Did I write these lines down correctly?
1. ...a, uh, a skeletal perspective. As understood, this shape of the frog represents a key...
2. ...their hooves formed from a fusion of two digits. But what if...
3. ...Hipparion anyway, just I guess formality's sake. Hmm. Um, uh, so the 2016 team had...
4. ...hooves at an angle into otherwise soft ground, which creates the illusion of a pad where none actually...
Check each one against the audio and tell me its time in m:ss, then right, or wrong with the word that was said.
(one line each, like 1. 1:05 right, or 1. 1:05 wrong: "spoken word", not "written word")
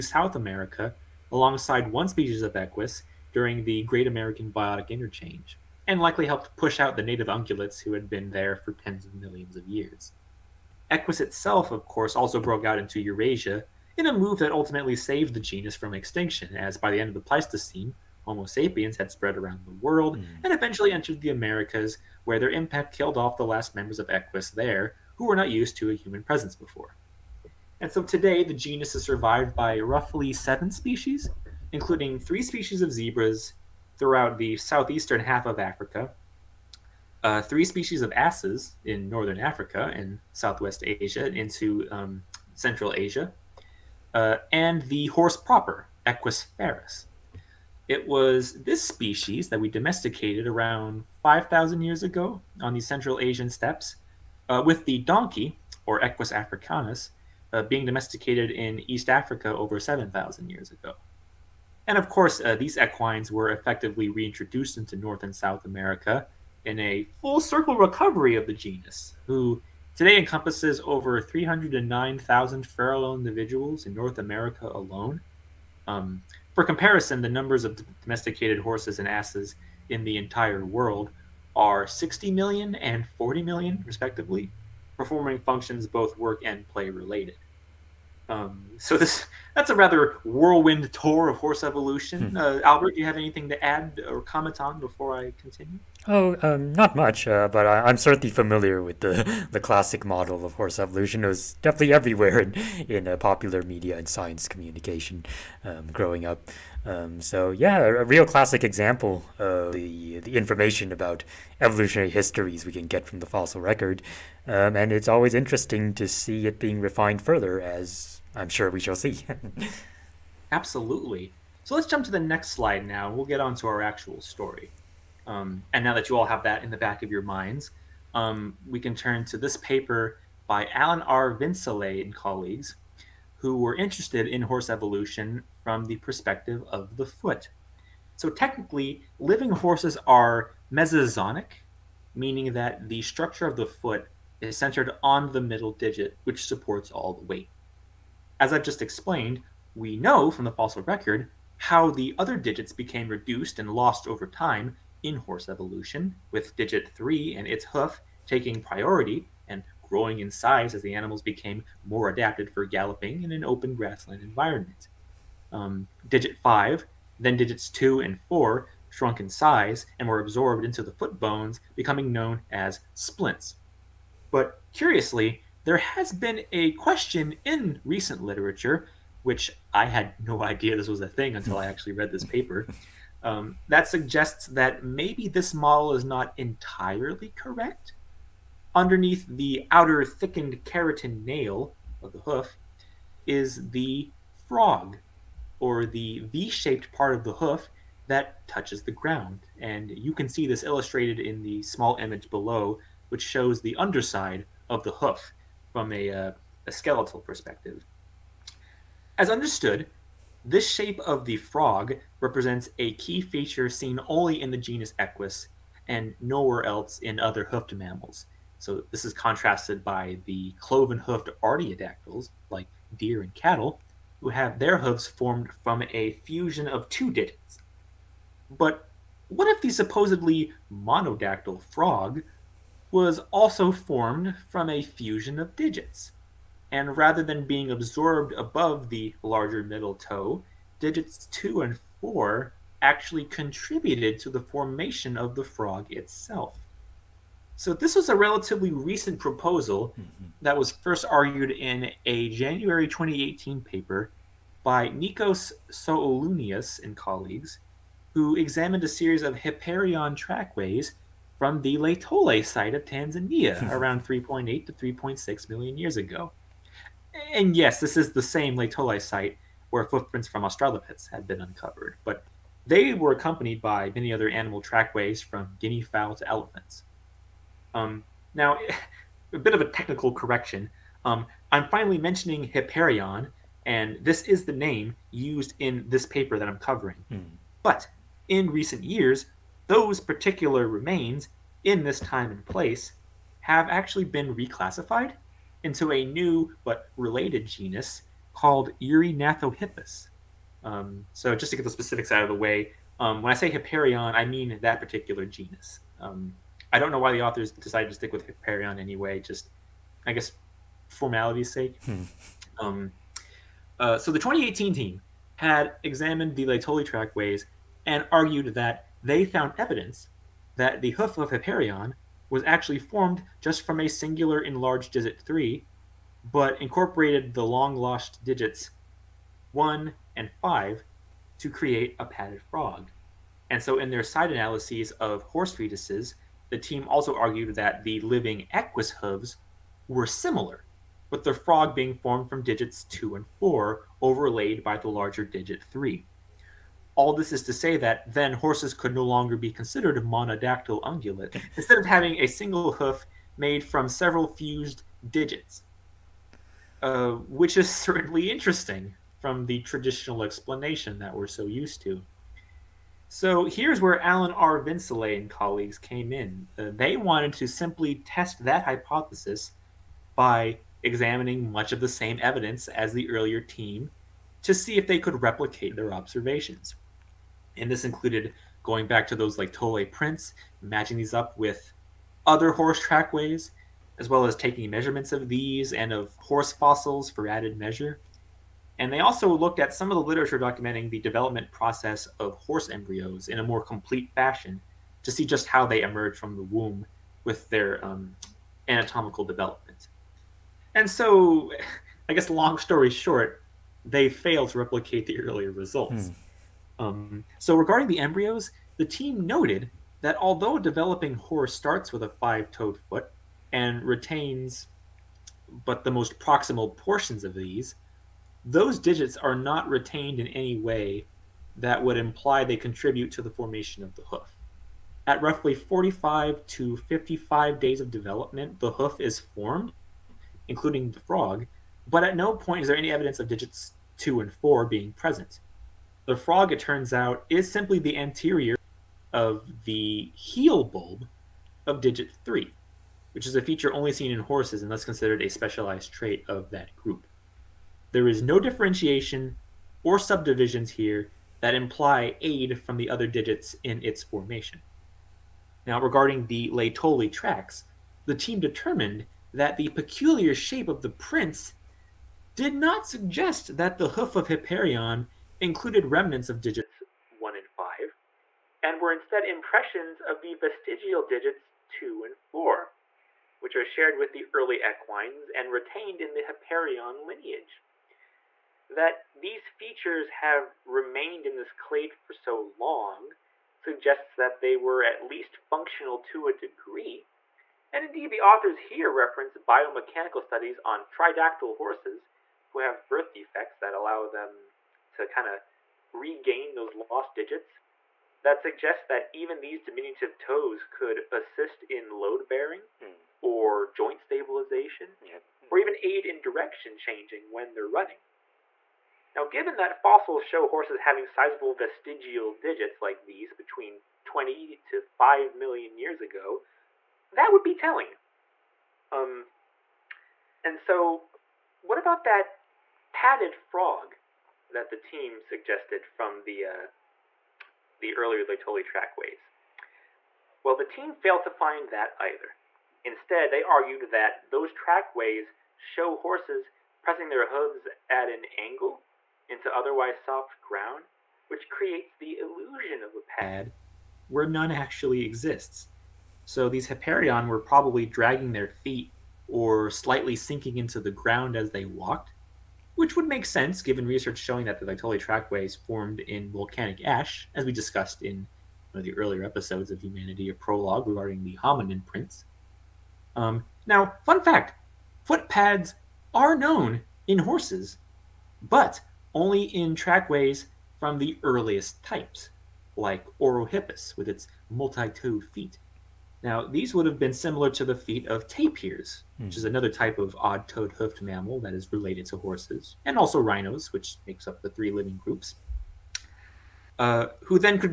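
1. 3:25 right
2. 3:44 right
3. 5:08 wrong: "2018", not "2016"
4. 8:57 right.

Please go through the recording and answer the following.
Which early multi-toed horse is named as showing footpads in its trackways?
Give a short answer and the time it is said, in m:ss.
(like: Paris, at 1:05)
Orohippus, at 9:33.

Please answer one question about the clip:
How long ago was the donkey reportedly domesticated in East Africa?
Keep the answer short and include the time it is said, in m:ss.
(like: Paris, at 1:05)
Over 7,000 years ago, at 0:59.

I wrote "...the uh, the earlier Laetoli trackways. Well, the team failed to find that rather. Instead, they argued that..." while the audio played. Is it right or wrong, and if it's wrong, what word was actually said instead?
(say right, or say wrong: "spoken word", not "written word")
wrong: "either", not "rather".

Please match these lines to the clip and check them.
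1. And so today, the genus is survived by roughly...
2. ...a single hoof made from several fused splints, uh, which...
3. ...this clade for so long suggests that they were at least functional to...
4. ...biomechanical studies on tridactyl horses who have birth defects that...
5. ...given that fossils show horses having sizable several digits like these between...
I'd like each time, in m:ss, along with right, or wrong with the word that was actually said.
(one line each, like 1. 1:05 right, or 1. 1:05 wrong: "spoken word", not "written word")
1. 0:27 right
2. 5:52 wrong: "digits", not "splints"
3. 8:01 right
4. 8:09 right
5. 8:29 wrong: "vestigial", not "several".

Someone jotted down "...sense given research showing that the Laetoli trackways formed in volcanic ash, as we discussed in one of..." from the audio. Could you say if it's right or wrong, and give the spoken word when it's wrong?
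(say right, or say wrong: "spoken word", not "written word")
right.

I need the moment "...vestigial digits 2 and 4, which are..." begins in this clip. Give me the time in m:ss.
7:50.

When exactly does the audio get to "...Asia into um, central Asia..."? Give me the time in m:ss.
0:40.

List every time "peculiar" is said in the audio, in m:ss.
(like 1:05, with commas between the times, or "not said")
7:39.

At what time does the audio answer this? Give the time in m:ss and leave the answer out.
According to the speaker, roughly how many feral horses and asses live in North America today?
1:11.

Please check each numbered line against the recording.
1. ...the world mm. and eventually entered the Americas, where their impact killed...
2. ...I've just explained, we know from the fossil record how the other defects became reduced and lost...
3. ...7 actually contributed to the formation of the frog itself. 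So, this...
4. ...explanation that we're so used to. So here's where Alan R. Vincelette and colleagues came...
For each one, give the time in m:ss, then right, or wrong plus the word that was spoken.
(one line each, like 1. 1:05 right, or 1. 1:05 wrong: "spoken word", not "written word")
1. 0:19 right
2. 2:28 wrong: "digits", not "defects"
3. 4:02 wrong: "4", not "7"
4. 6:00 right.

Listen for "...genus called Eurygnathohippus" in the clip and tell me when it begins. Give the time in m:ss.
4:57.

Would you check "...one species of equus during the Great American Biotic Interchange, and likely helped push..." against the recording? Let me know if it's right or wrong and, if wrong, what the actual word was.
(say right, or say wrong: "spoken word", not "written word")
right.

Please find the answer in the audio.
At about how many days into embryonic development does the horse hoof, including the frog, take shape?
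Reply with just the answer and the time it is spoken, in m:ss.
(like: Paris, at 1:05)
45 to 55 days, at 7:05.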